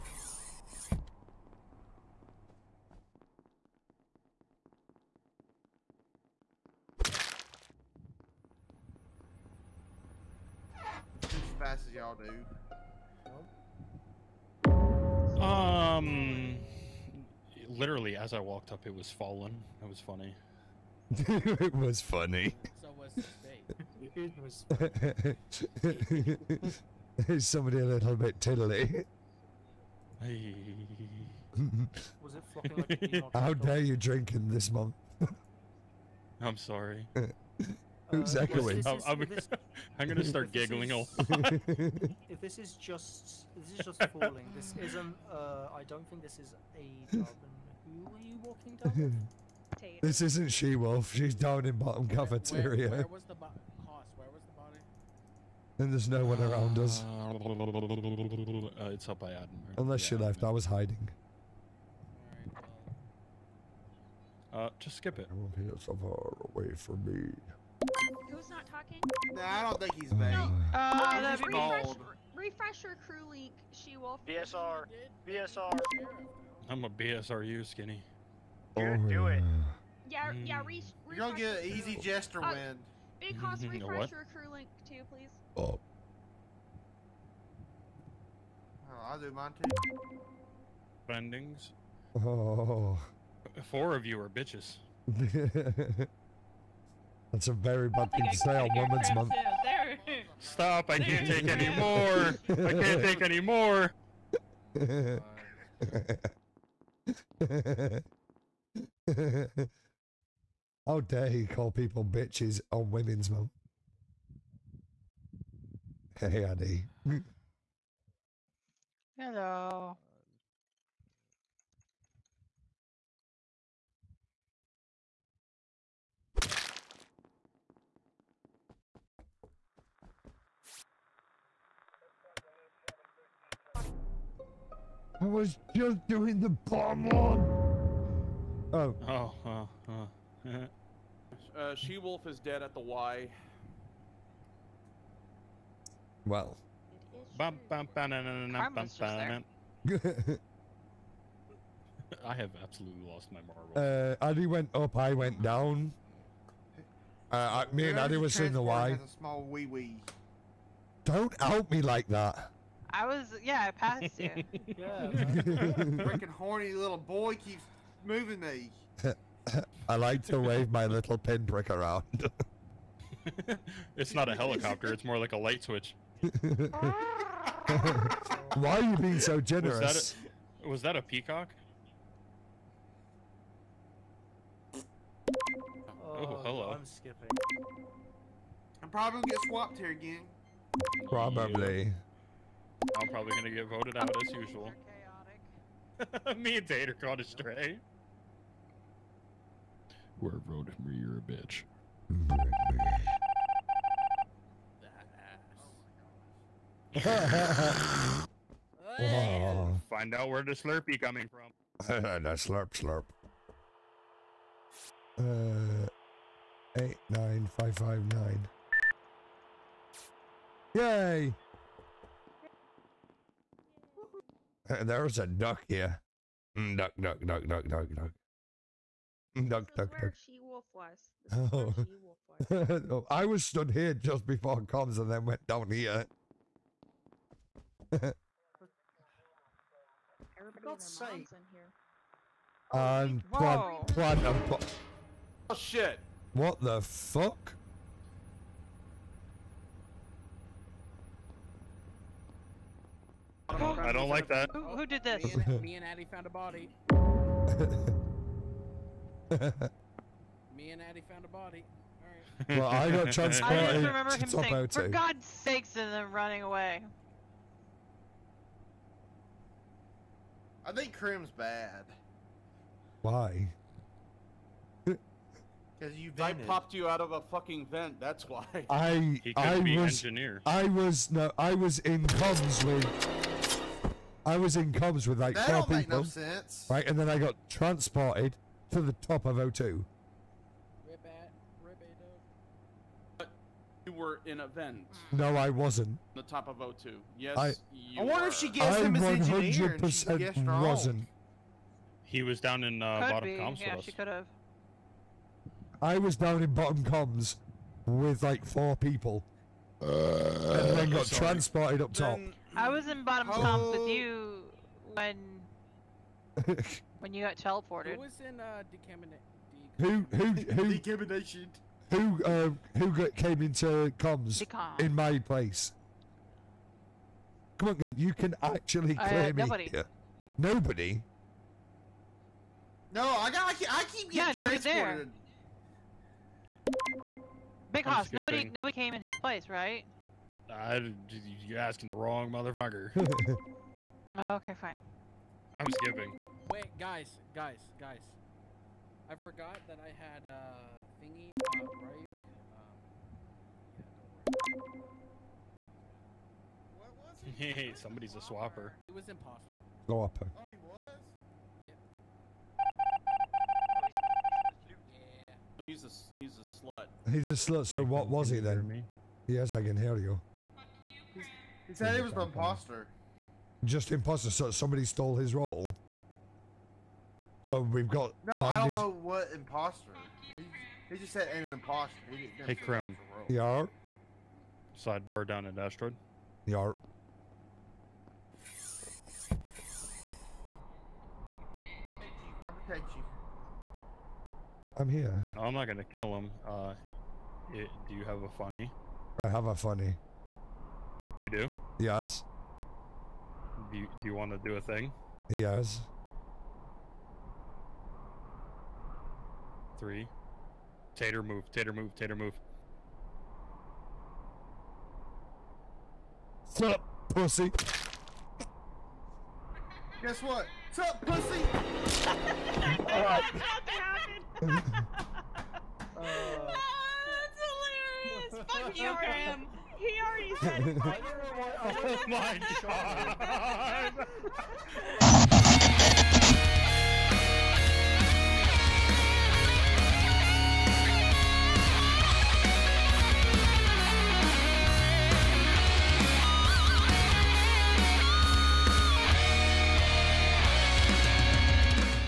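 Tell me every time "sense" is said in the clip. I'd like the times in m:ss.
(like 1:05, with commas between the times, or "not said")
4:46.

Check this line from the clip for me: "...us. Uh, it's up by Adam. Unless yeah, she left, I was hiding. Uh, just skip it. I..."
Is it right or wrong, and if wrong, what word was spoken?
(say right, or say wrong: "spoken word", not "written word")
right.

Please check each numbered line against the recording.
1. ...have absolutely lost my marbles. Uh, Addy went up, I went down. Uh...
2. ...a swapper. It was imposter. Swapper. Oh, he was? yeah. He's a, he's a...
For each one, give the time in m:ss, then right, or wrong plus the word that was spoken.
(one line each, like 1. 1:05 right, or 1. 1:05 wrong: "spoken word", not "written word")
1. 2:32 right
2. 5:58 right.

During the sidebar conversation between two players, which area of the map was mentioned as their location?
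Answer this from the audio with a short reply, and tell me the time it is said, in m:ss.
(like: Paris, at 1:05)
Asteroid, at 6:25.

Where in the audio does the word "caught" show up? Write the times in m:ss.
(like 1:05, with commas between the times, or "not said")
3:16.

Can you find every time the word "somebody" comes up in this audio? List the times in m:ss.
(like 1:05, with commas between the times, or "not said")
0:27, 5:57, 6:14.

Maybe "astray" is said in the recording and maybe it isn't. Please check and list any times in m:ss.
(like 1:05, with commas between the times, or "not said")
3:17.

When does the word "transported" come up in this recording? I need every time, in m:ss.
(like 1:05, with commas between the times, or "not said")
4:23, 4:47, 5:11.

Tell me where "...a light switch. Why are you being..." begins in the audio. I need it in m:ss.
2:55.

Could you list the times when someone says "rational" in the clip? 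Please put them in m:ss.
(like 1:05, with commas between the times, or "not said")
not said.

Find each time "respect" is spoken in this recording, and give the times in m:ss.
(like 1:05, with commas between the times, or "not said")
not said.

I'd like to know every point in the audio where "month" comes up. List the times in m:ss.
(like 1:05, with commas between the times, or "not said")
0:34, 1:39, 1:53.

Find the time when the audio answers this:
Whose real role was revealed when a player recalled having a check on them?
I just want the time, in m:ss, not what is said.
5:51.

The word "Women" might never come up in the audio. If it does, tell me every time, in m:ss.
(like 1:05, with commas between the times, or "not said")
1:38, 1:52.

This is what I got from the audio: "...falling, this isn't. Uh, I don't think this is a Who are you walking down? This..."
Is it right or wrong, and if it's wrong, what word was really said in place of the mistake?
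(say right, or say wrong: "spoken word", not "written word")
right.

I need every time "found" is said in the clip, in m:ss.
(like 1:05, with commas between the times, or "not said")
4:16, 4:21.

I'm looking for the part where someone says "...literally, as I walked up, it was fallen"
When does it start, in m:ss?
0:17.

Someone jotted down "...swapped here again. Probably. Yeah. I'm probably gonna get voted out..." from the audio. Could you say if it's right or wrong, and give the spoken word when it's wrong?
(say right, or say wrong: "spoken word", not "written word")
right.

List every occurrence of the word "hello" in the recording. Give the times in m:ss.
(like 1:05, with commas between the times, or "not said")
1:59, 3:06.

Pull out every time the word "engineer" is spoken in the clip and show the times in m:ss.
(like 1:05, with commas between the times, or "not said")
4:40, 4:59.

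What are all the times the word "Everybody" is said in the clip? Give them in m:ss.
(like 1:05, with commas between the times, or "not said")
3:57.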